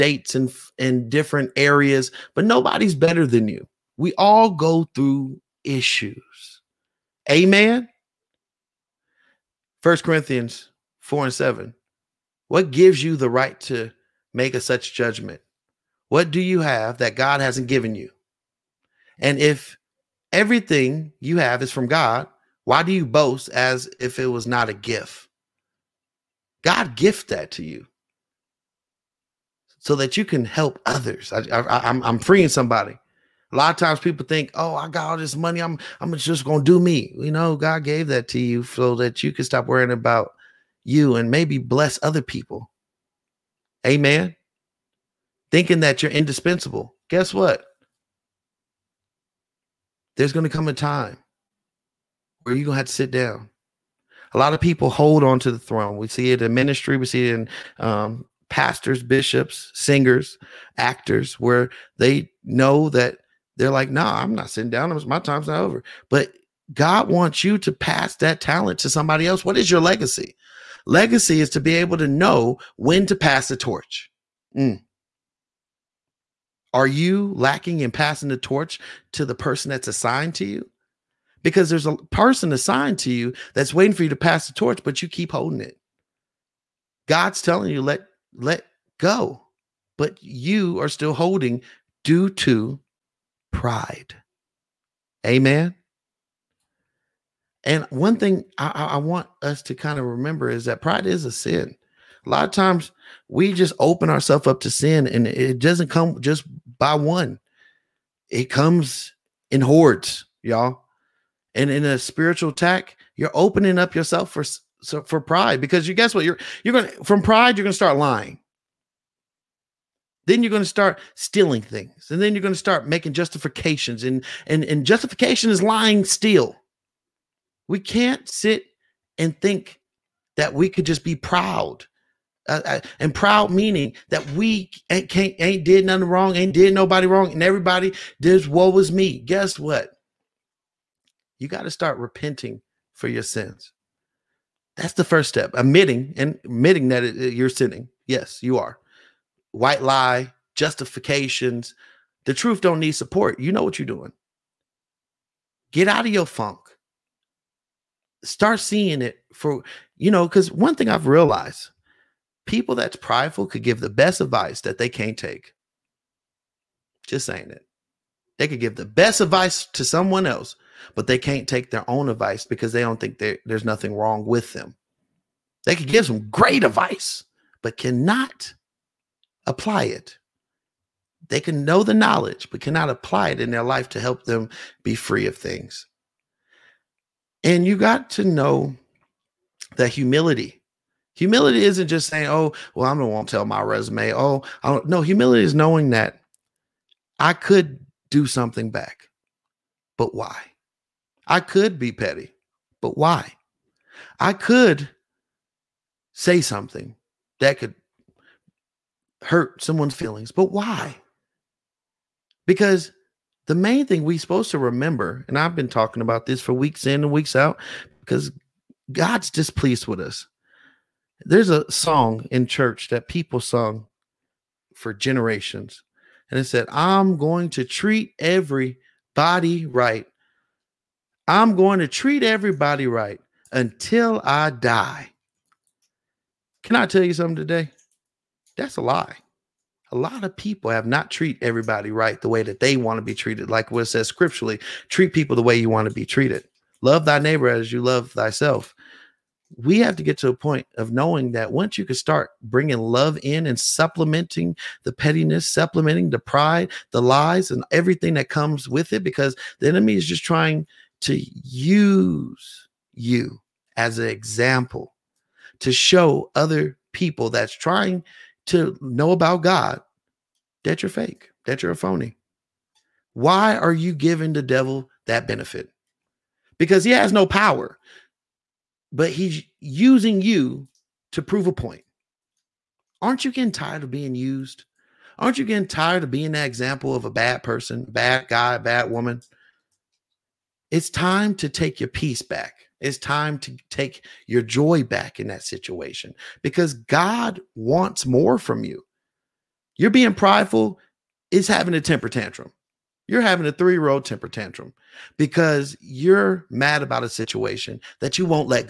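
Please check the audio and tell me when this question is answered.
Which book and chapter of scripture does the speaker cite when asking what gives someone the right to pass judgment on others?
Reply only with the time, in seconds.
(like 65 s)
9 s.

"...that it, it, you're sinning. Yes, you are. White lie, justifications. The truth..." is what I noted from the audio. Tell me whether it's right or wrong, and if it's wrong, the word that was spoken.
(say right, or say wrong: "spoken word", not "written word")
right.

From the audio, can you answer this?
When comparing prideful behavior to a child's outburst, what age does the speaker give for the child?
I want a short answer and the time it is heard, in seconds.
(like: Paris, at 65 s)
3, at 303 s.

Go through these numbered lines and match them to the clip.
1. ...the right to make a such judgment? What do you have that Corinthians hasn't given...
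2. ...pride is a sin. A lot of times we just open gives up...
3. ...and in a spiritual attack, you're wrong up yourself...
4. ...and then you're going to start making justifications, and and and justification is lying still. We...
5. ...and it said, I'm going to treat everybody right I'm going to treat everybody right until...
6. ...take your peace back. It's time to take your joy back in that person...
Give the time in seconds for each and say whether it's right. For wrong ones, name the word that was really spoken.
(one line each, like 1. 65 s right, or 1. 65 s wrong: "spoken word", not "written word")
1. 13 s wrong: "God", not "Corinthians"
2. 100 s wrong: "ourselves", not "gives"
3. 111 s wrong: "opening", not "wrong"
4. 122 s right
5. 226 s right
6. 291 s wrong: "situation", not "person".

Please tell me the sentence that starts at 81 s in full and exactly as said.
because there's a person assigned to you that's waiting for you to pass the torch, but you keep holding it.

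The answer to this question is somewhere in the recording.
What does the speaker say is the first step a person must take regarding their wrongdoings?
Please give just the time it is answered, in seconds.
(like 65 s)
141 s.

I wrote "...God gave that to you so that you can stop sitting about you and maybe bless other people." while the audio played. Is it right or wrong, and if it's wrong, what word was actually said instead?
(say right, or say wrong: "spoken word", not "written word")
wrong: "worrying", not "sitting".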